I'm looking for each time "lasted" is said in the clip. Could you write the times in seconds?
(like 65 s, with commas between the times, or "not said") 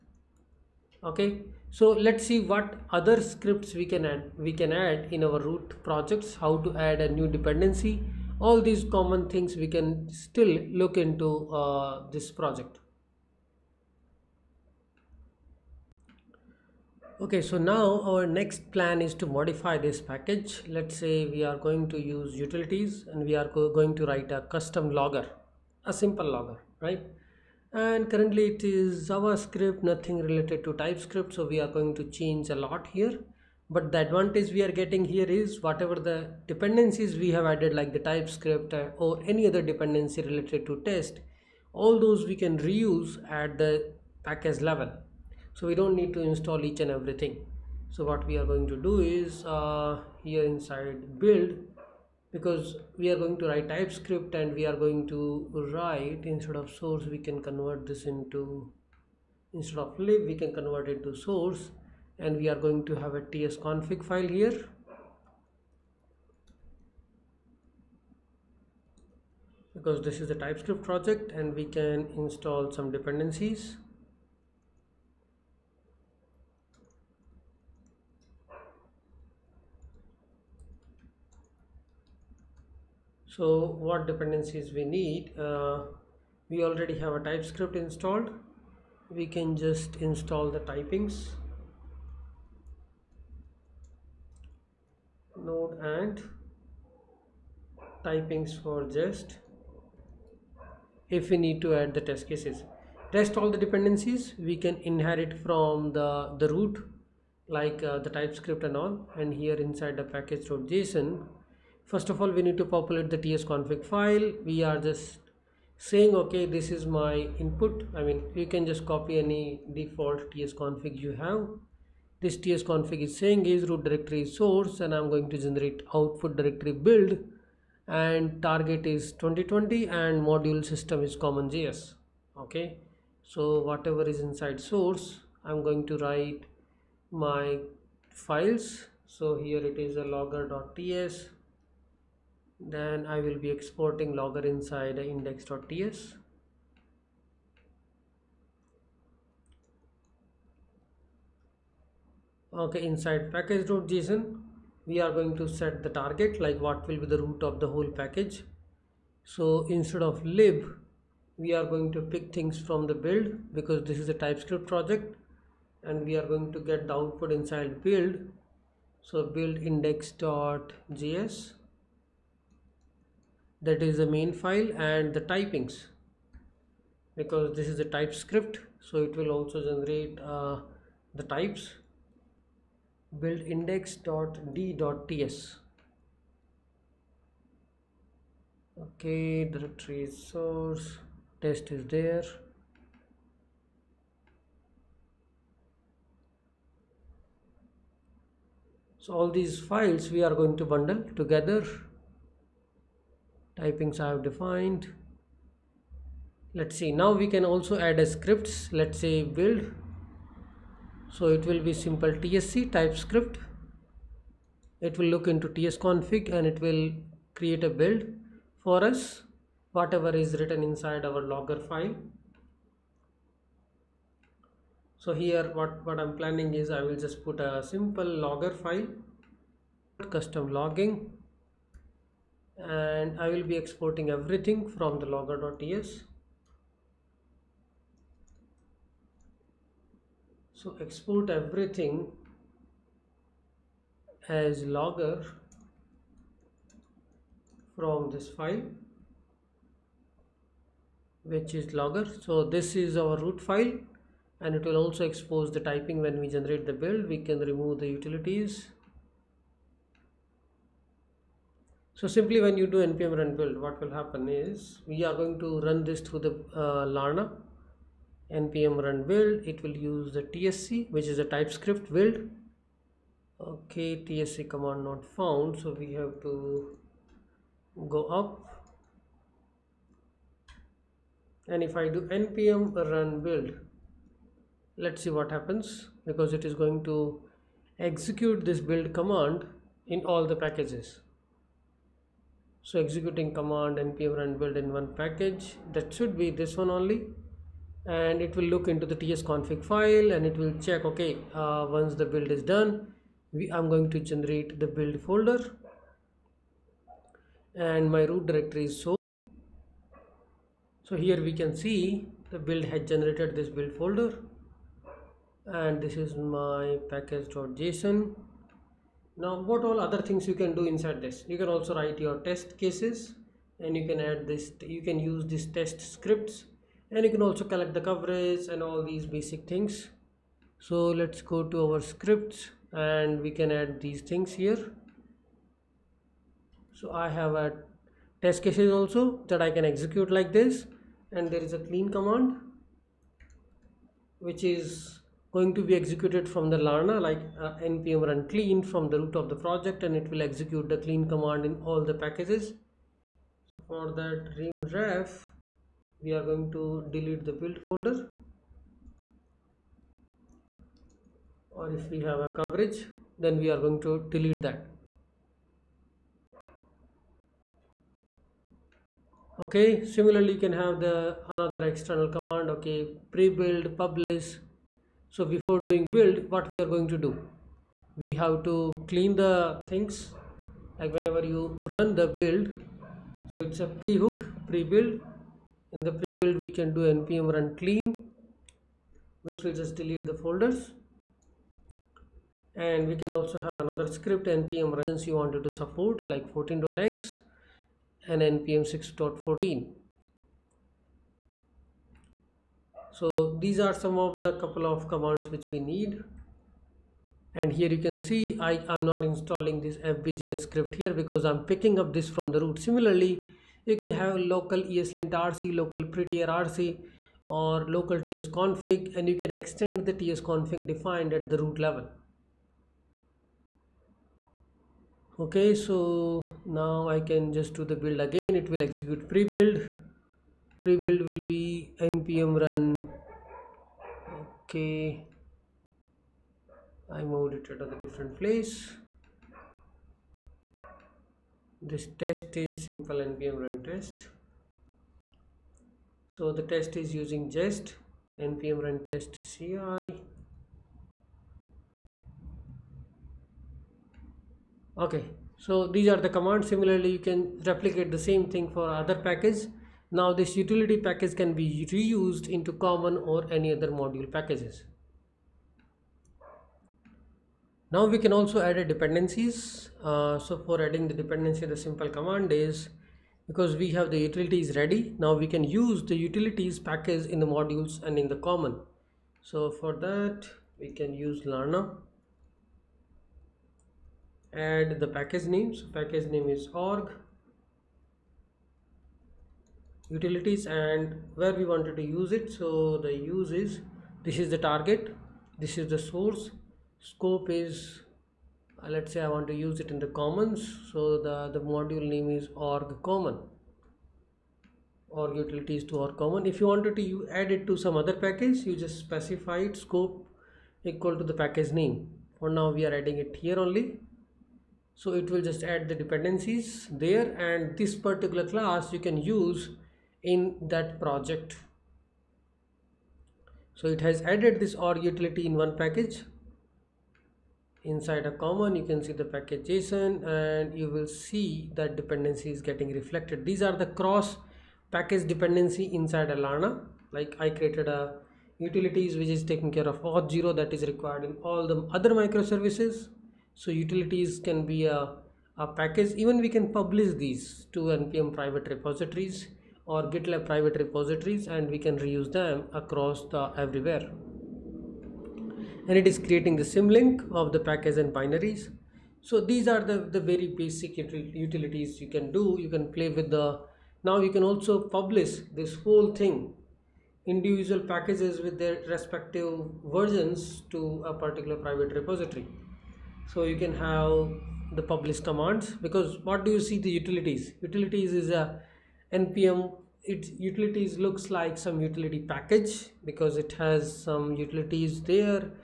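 not said.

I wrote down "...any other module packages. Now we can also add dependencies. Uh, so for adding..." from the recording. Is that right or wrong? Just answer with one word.
right.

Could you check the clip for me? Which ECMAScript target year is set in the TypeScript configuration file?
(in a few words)
2020.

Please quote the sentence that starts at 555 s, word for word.
And it is creating the symlink of the package and binaries.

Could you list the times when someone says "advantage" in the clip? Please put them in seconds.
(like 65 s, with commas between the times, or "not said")
33 s.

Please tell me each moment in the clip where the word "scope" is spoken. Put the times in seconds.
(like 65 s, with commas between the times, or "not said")
496 s, 509 s.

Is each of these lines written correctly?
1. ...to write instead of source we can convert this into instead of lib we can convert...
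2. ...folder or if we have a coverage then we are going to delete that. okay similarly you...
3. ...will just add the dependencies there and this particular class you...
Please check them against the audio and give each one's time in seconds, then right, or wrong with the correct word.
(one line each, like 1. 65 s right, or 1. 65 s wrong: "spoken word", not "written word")
1. 55 s right
2. 357 s right
3. 515 s right.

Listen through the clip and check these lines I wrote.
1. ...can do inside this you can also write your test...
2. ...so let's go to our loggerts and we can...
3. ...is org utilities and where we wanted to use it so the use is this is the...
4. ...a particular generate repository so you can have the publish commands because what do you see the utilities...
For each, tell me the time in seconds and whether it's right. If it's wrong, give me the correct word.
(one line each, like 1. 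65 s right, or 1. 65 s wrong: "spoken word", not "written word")
1. 320 s right
2. 330 s wrong: "scripts", not "loggerts"
3. 486 s right
4. 570 s wrong: "private", not "generate".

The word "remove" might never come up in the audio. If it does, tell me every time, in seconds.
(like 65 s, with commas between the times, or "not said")
257 s.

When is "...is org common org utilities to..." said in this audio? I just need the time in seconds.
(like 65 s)
502 s.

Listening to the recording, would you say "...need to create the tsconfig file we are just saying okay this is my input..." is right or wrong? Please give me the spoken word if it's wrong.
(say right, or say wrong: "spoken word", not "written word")
wrong: "populate", not "create".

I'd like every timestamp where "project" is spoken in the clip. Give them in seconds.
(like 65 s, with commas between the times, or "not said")
5 s, 12 s, 70 s, 164 s, 349 s, 520 s.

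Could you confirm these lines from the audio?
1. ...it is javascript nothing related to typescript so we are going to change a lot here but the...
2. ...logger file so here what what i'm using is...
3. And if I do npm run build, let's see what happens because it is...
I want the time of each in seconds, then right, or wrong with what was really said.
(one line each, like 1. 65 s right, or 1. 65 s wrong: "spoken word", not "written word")
1. 28 s right
2. 221 s wrong: "planning", not "using"
3. 281 s right.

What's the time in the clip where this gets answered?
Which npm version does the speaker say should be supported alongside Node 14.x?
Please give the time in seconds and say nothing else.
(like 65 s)
398 s.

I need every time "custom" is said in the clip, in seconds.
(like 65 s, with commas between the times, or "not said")
24 s, 230 s.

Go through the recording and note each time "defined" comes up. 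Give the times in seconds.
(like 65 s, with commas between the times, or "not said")
204 s, 420 s.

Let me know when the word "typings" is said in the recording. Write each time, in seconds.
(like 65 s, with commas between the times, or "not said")
90 s, 98 s, 175 s, 203 s, 255 s.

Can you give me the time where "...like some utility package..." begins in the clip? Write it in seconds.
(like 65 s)
581 s.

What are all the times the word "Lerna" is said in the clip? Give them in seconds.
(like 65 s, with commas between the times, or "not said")
346 s, 481 s.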